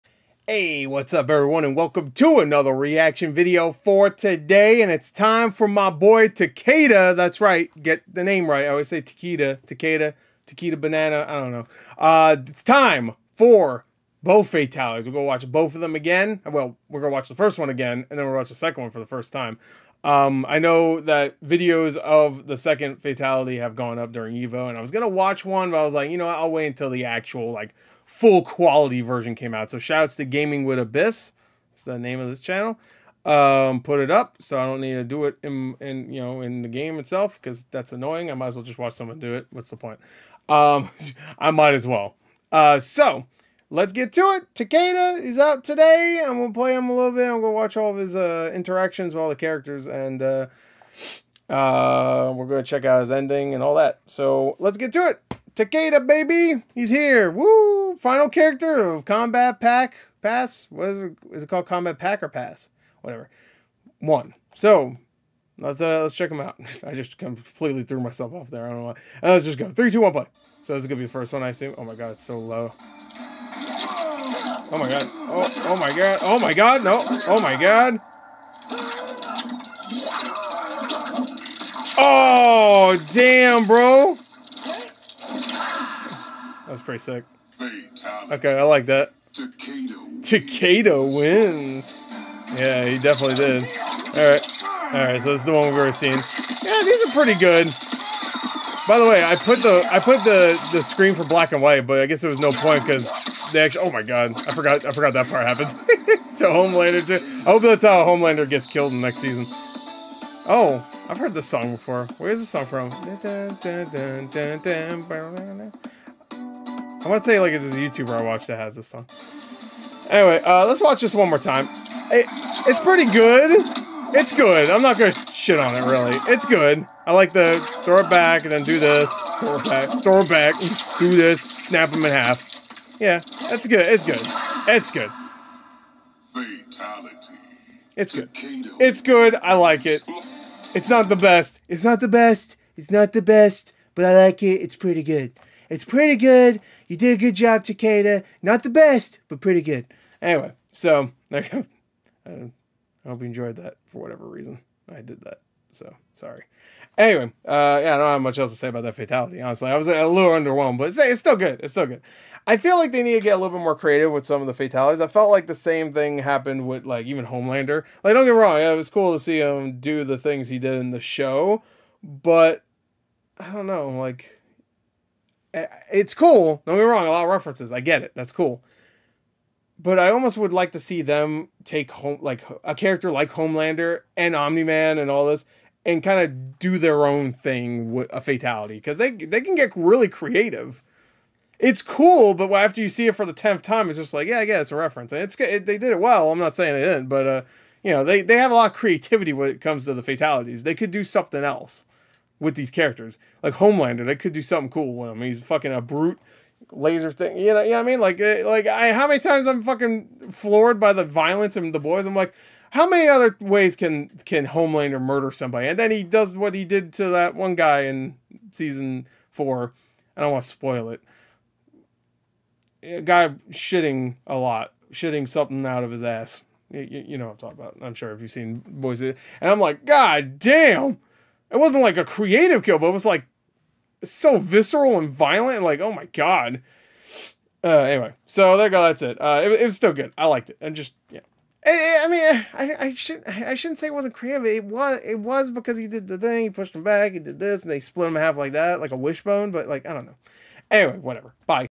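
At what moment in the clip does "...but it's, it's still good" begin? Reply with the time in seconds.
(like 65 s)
160 s.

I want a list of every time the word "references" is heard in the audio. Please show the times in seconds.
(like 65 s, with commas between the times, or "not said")
177 s, 194 s.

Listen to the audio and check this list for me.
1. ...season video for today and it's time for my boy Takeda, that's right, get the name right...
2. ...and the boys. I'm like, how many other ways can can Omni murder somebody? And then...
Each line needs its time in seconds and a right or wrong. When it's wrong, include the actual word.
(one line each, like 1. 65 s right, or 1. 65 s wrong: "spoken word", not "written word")
1. 2 s wrong: "reaction", not "season"
2. 211 s wrong: "Homelander", not "Omni".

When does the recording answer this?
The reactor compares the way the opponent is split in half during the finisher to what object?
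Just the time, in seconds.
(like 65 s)
248 s.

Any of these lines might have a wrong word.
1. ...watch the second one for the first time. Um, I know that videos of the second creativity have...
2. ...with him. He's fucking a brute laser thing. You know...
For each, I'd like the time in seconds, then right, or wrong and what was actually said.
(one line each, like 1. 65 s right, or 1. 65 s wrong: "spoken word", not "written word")
1. 18 s wrong: "fatality", not "creativity"
2. 204 s right.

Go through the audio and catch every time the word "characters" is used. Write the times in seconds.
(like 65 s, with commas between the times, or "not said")
49 s, 58 s, 182 s, 202 s.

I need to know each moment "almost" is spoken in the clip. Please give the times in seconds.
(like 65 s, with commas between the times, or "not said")
180 s.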